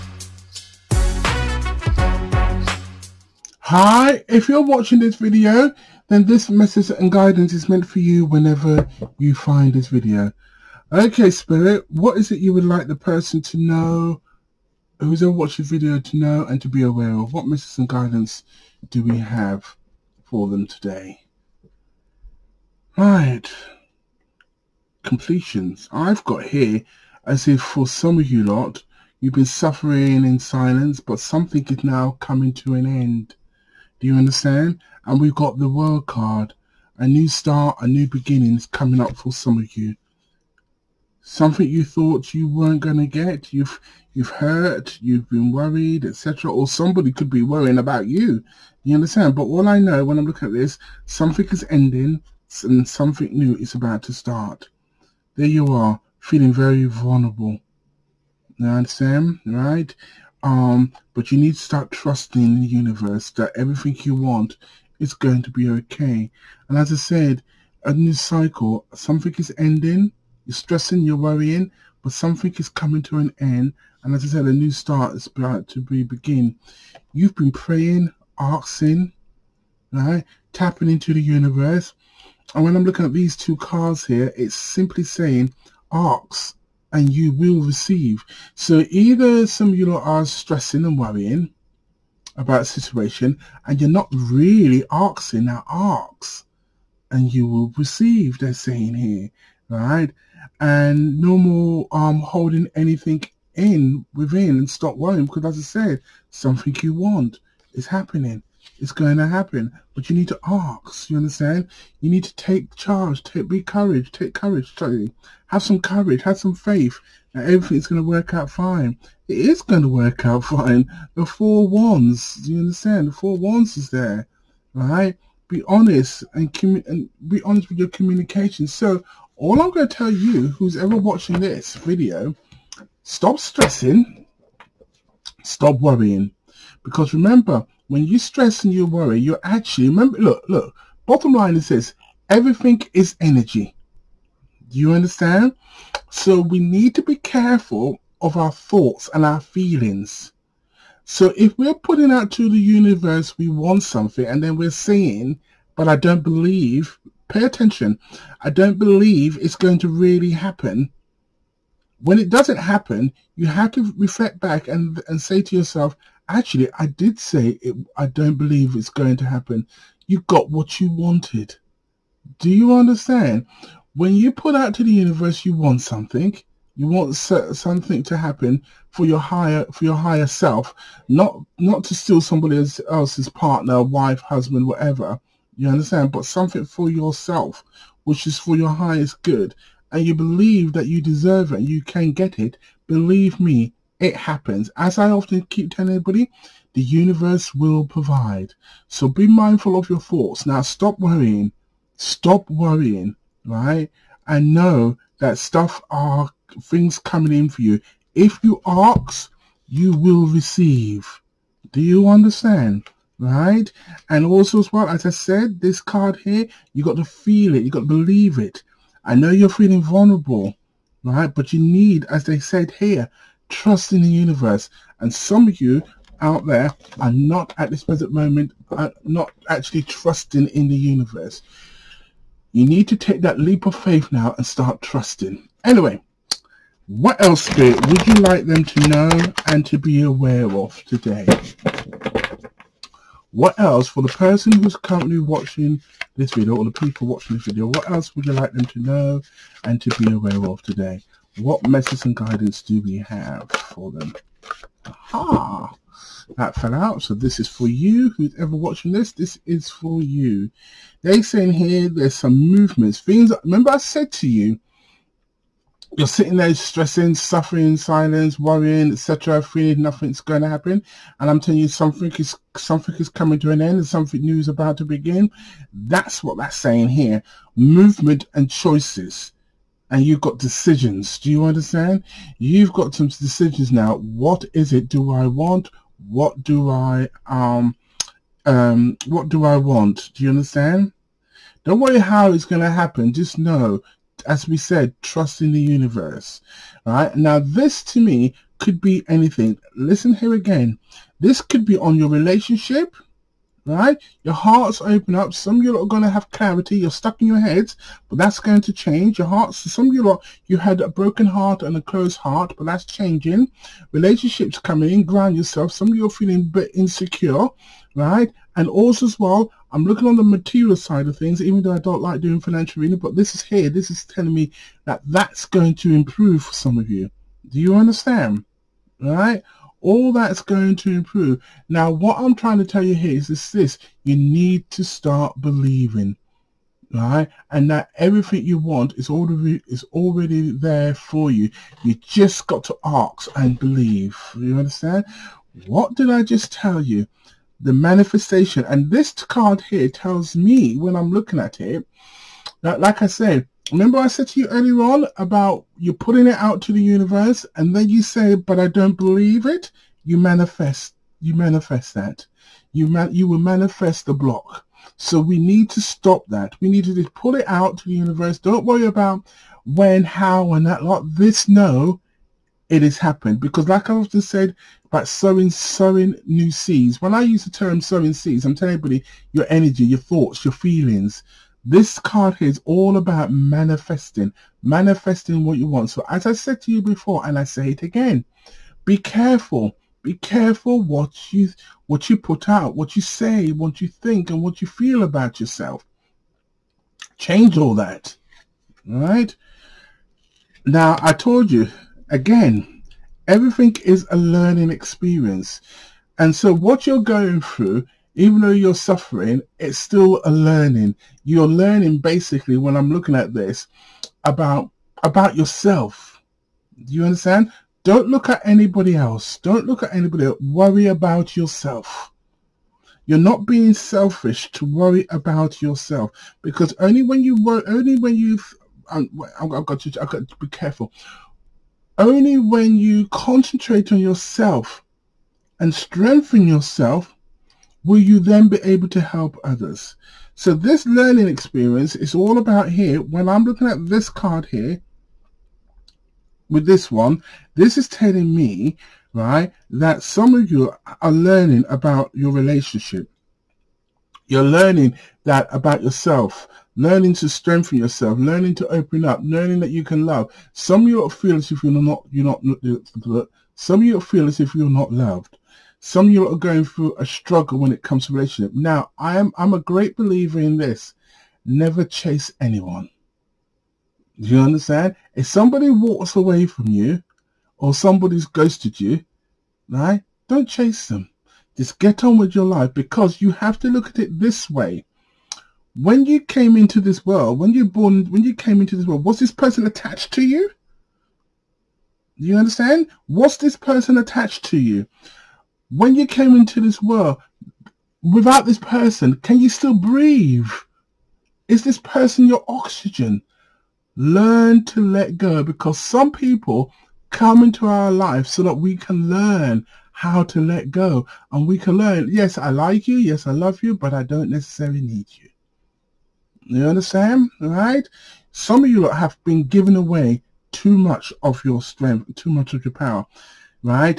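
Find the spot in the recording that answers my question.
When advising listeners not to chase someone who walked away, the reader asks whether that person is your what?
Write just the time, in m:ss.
8:22.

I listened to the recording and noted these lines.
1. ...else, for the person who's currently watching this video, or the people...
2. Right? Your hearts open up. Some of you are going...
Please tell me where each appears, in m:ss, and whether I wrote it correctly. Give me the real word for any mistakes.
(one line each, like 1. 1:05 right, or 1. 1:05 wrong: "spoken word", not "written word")
1. 4:03 right
2. 5:03 right.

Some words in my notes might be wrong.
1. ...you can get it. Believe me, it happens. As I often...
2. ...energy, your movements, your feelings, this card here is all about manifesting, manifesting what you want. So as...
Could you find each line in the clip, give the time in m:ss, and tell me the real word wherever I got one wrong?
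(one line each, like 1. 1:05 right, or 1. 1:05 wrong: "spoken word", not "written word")
1. 3:11 right
2. 6:19 wrong: "thoughts", not "movements".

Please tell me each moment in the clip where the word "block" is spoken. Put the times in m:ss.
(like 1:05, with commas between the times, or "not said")
6:04.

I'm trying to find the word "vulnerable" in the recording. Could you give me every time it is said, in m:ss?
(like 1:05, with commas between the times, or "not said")
0:56, 3:39.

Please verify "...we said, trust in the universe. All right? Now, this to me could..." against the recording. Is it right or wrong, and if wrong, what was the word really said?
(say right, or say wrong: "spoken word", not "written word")
right.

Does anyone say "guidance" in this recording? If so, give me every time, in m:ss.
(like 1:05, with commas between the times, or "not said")
0:07, 0:17, 4:12.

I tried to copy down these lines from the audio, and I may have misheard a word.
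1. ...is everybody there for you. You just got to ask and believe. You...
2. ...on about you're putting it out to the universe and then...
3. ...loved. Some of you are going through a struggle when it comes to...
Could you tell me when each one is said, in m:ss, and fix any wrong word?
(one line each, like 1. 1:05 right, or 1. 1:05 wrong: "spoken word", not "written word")
1. 5:39 wrong: "already", not "everybody"
2. 5:54 right
3. 7:44 right.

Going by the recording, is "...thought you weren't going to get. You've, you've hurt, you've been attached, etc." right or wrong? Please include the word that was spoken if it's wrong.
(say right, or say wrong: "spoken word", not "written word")
wrong: "worried", not "attached".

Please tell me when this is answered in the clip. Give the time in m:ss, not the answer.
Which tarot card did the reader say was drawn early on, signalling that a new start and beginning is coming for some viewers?
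0:35.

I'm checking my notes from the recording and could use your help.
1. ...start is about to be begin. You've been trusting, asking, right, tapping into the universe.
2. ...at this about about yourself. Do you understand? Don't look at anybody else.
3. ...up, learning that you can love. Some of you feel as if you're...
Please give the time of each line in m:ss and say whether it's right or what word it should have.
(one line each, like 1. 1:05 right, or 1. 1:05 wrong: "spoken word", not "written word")
1. 1:14 wrong: "praying", not "trusting"
2. 6:53 right
3. 7:39 right.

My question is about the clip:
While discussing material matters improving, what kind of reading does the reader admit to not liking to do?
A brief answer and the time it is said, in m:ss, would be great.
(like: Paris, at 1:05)
Financial reading, at 5:22.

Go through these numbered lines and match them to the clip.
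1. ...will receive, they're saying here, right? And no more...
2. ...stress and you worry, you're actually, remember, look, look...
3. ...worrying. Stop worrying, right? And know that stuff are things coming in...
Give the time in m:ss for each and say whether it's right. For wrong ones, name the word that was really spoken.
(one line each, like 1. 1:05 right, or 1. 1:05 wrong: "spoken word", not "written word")
1. 1:37 right
2. 2:18 right
3. 3:20 right.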